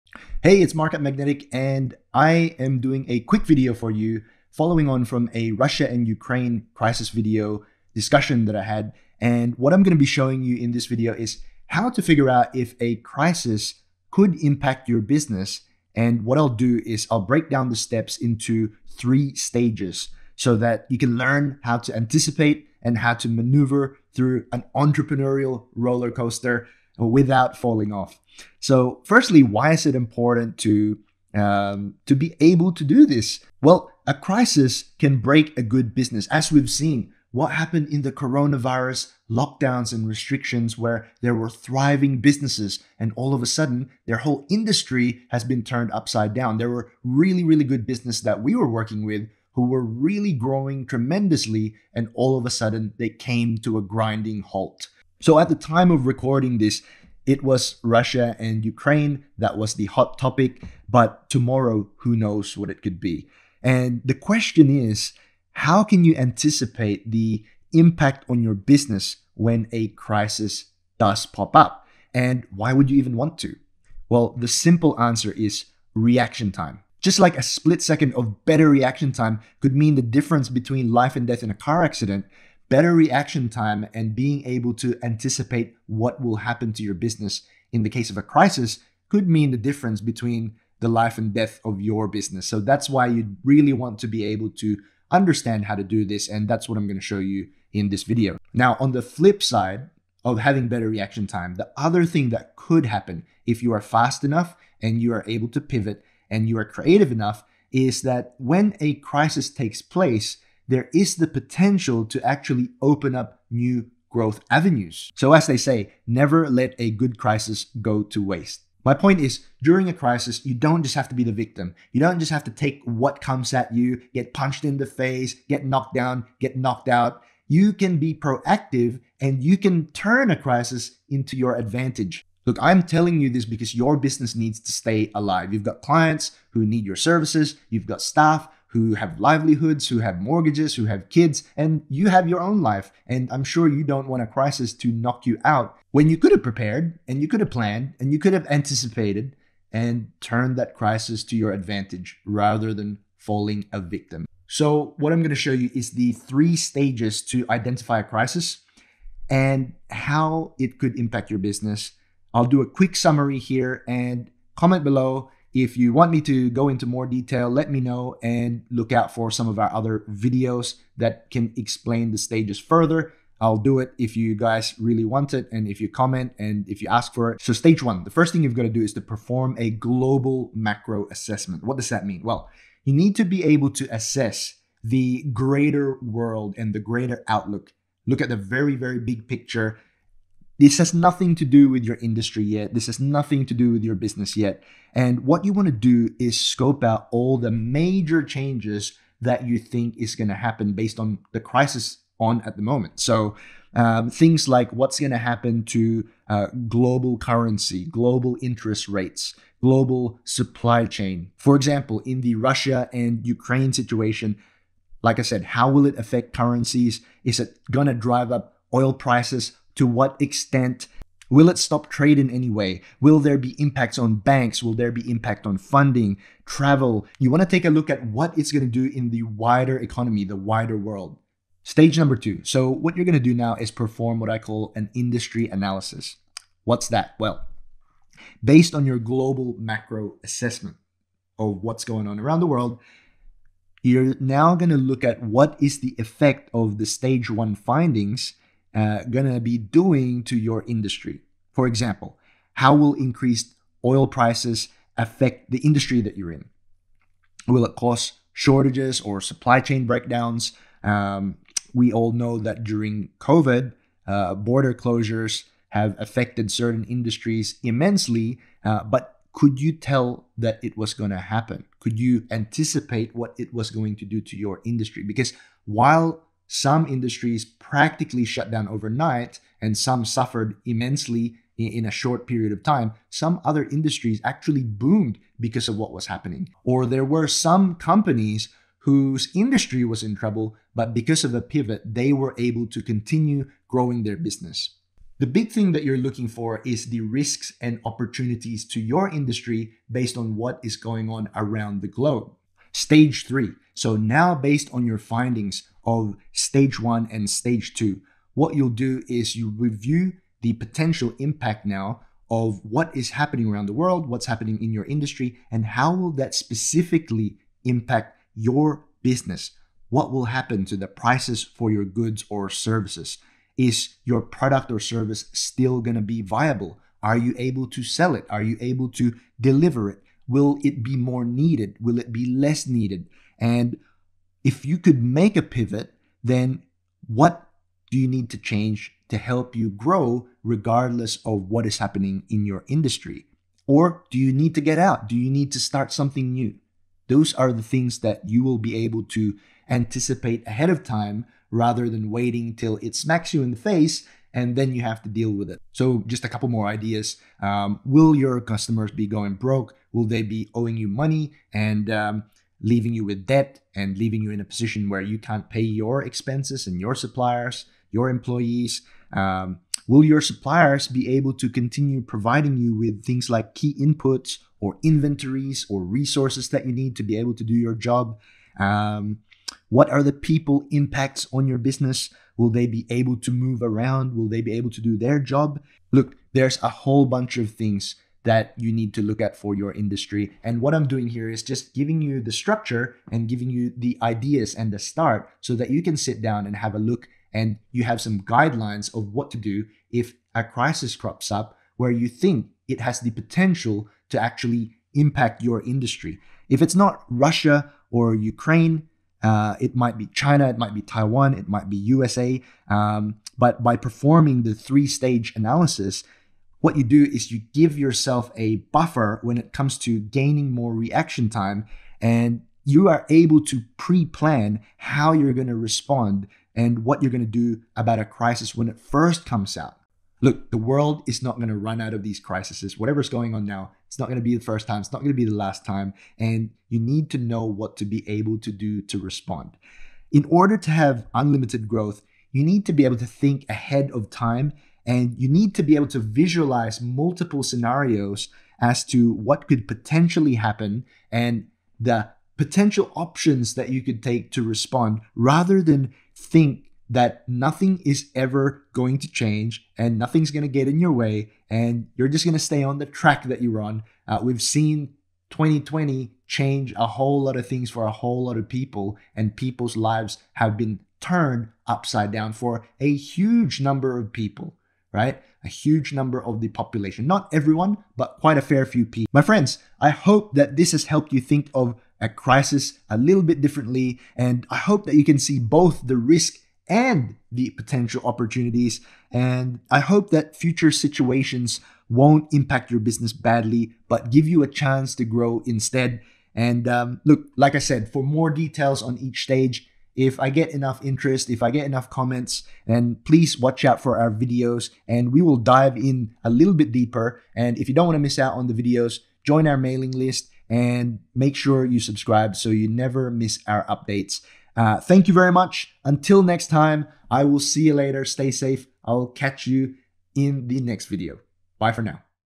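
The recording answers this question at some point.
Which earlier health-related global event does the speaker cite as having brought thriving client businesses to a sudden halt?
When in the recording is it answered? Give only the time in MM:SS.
00:38.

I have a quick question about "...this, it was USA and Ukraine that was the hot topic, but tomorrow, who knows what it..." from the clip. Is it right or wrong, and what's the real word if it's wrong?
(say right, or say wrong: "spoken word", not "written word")
wrong: "Russia", not "USA".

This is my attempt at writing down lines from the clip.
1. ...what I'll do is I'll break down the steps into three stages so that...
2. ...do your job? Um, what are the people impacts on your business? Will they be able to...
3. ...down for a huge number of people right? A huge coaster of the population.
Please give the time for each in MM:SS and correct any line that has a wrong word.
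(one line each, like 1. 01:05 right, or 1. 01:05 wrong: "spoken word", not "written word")
1. 00:16 right
2. 06:17 right
3. 07:52 wrong: "number", not "coaster".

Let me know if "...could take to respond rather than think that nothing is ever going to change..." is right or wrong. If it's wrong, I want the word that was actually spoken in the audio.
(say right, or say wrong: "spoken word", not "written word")
right.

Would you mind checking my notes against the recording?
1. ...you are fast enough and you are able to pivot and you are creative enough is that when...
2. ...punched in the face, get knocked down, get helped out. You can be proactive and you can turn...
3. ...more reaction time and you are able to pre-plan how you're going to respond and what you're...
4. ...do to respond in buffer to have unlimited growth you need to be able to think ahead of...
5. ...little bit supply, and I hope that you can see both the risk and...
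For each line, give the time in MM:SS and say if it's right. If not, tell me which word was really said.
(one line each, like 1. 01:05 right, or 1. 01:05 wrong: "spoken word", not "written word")
1. 01:43 right
2. 02:04 wrong: "knocked", not "helped"
3. 07:00 right
4. 07:18 wrong: "order", not "buffer"
5. 08:02 wrong: "differently", not "supply".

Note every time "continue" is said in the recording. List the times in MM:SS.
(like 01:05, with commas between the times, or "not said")
04:52, 06:11.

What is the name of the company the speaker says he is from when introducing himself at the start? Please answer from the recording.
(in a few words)
Magnetic.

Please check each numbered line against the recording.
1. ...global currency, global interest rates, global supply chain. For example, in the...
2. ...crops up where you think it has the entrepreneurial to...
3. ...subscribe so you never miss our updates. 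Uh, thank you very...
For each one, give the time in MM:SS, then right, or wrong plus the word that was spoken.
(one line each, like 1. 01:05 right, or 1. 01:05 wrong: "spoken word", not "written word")
1. 03:26 right
2. 06:40 wrong: "potential", not "entrepreneurial"
3. 08:31 right.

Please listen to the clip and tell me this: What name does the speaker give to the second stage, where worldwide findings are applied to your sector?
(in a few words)
Industry analysis.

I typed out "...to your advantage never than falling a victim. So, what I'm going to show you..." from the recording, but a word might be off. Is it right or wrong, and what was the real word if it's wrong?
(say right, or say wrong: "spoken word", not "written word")
wrong: "rather", not "never".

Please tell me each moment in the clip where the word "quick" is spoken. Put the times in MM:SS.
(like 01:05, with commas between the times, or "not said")
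00:03, 02:42.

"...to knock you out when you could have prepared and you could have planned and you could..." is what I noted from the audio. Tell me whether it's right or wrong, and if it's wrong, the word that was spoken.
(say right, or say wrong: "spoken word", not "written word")
right.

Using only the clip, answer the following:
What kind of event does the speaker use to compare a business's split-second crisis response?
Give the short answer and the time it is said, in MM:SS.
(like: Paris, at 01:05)
A car accident, at 01:21.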